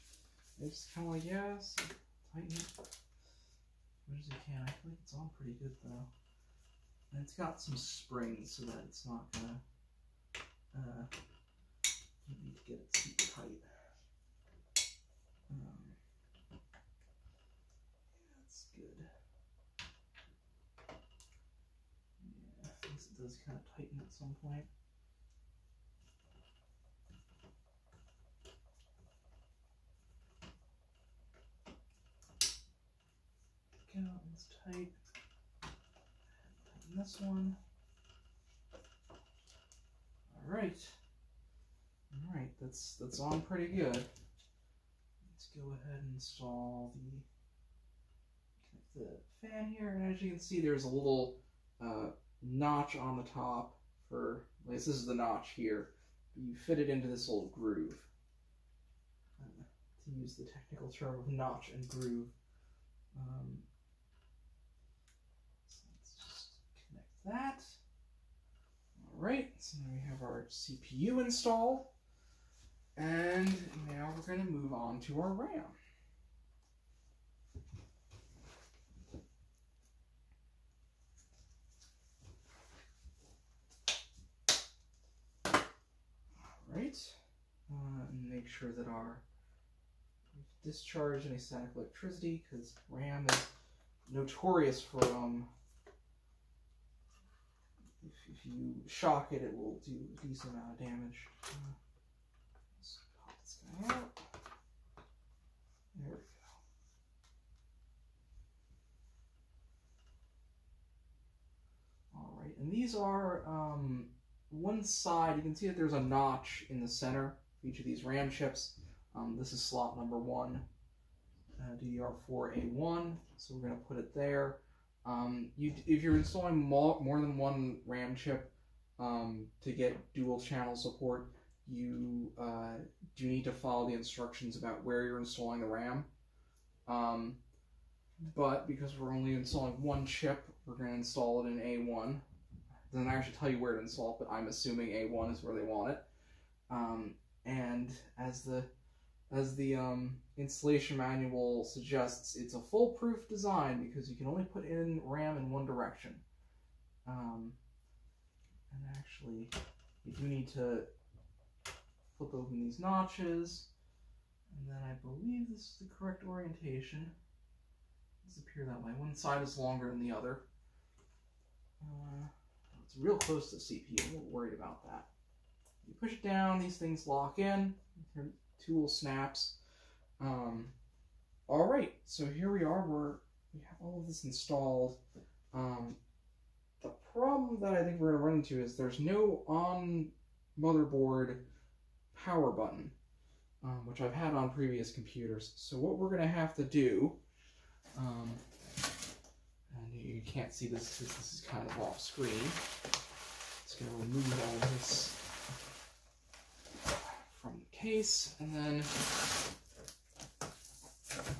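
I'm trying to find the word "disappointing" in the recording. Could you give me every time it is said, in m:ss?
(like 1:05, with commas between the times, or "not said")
not said.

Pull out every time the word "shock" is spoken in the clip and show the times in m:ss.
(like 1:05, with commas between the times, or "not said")
1:38.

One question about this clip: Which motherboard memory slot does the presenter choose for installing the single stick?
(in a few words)
DDR4A1.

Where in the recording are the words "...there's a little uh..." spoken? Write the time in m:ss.
0:50.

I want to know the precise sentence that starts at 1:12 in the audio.
And now we're going to move on to our RAM.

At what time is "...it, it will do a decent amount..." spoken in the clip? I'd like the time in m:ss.
1:39.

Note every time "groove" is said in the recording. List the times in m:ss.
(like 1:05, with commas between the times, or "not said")
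0:57, 1:01.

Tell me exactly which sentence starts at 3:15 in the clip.
So what we're going to have to do um, and you can't see this because this is kind of off screen.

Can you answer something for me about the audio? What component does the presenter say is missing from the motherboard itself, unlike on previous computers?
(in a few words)
power button.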